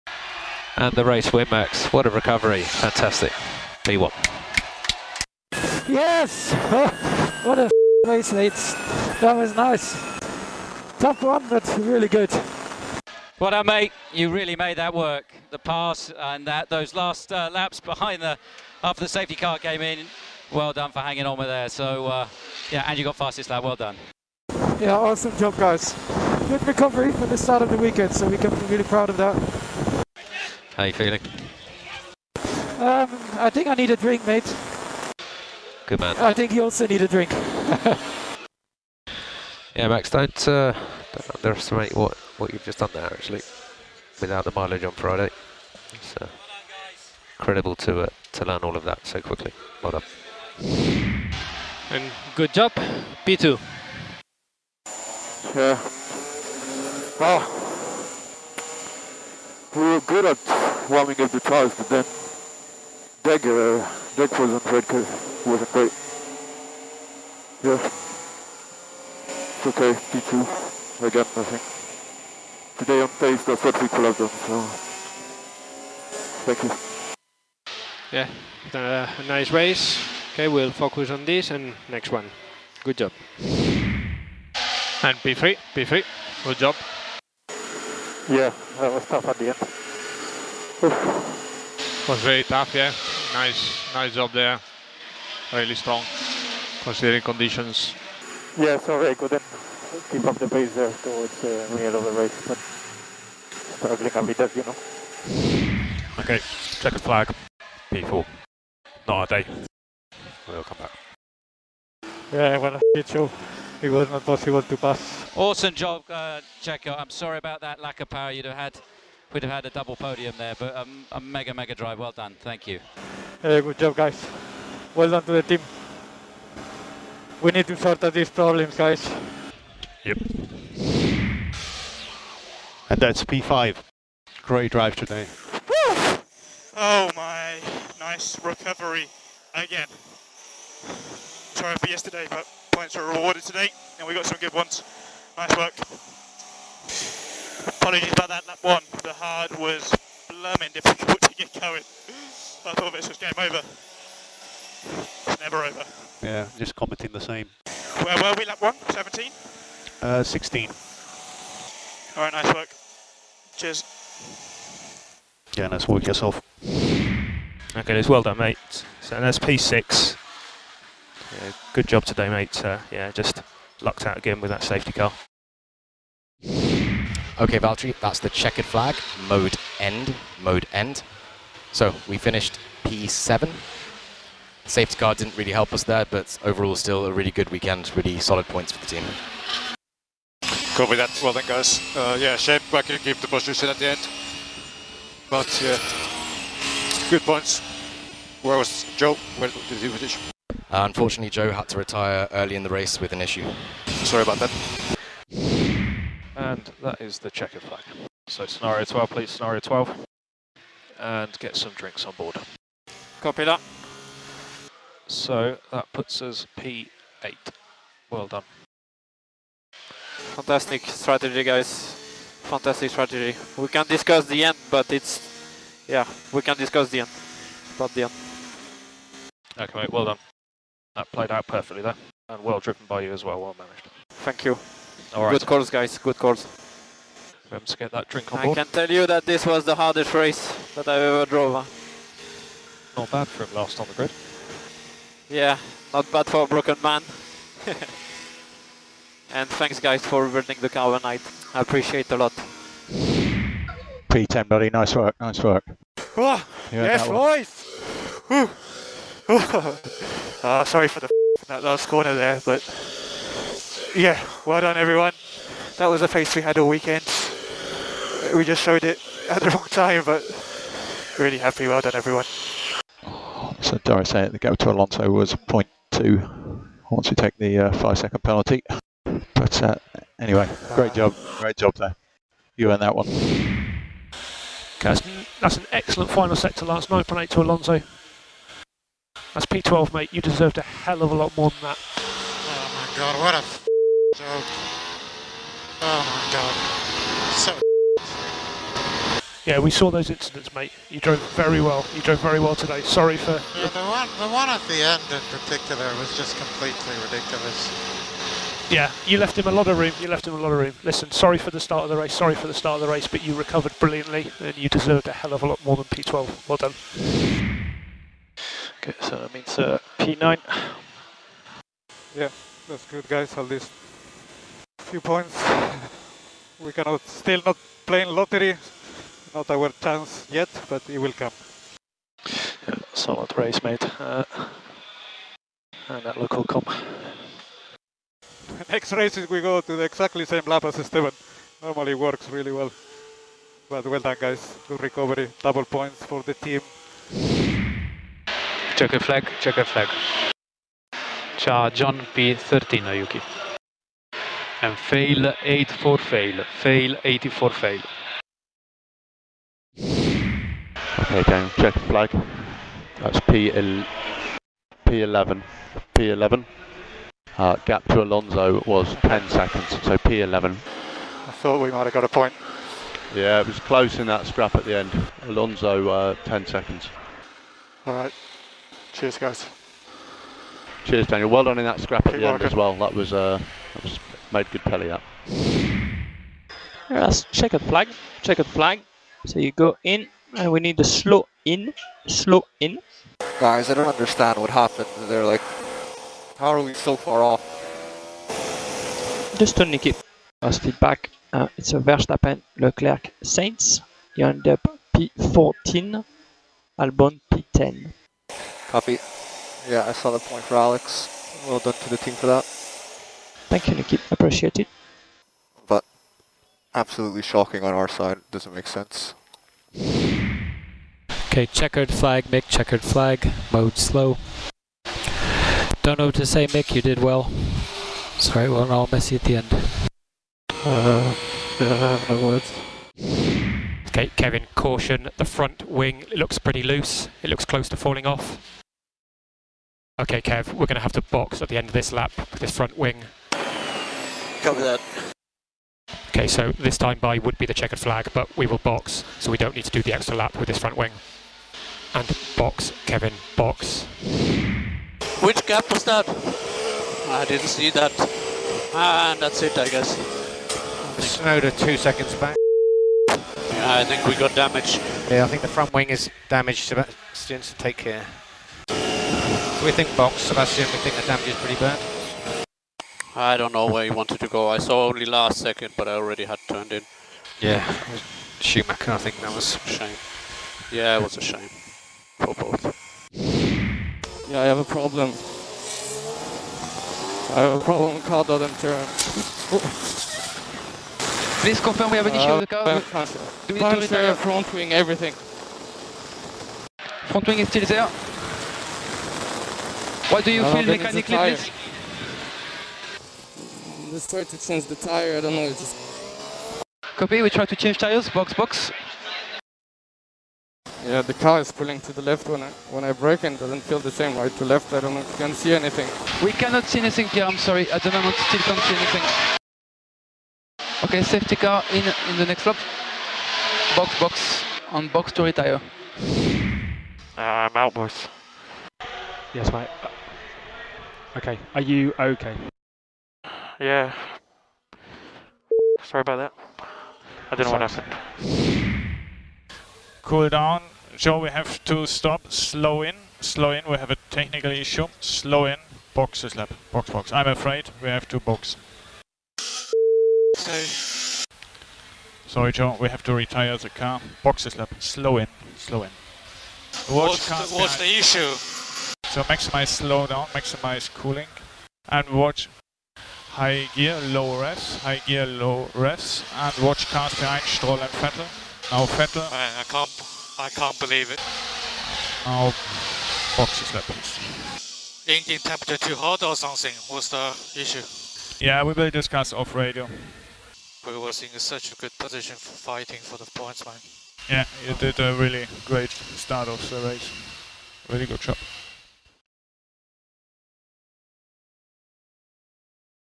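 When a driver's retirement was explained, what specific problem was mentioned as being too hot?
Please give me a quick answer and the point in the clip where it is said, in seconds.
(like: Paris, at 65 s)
Engine temperature, at 575 s.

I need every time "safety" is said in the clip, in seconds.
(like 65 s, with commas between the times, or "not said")
19 s, 174 s, 184 s, 521 s.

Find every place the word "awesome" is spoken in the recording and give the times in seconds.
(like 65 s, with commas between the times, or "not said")
24 s, 115 s.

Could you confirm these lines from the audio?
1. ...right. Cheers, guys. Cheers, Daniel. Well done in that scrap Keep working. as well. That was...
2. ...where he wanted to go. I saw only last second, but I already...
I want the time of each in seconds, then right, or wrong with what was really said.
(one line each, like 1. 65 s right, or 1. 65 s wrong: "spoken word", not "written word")
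1. 377 s right
2. 473 s right.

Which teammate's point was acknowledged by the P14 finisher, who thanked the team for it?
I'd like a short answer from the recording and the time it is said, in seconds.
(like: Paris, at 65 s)
Alex, at 410 s.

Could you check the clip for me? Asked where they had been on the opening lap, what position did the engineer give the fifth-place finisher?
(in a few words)
16.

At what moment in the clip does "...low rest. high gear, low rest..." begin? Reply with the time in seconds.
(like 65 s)
564 s.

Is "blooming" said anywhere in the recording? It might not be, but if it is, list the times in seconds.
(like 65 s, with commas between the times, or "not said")
150 s.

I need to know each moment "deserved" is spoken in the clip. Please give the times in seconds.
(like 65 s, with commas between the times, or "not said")
290 s, 314 s.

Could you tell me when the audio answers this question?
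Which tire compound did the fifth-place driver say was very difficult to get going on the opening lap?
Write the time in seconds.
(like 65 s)
149 s.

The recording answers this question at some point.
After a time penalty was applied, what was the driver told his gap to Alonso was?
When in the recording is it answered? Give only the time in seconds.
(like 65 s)
275 s.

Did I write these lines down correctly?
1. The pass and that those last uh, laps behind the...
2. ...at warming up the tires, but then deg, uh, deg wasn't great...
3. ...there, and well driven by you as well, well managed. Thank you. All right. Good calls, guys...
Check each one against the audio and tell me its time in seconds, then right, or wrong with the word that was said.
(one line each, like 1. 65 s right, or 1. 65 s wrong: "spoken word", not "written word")
1. 15 s right
2. 60 s right
3. 231 s right.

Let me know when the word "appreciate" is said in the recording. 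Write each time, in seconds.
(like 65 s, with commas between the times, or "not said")
251 s, 414 s.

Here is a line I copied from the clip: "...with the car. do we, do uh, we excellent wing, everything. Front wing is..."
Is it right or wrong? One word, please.
wrong.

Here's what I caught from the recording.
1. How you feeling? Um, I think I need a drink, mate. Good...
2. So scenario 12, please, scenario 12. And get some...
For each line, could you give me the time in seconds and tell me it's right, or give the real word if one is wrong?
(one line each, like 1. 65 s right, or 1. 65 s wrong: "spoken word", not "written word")
1. 30 s right
2. 208 s right.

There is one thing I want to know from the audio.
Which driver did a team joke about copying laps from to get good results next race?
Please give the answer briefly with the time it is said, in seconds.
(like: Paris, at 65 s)
Esteban, at 340 s.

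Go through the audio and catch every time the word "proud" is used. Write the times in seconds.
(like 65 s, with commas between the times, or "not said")
28 s.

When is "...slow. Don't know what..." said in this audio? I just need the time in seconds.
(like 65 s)
423 s.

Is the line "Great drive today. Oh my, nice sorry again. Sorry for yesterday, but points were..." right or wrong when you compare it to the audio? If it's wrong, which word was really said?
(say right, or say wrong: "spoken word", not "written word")
wrong: "recovery", not "sorry".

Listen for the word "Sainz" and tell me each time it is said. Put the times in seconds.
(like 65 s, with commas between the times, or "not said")
403 s.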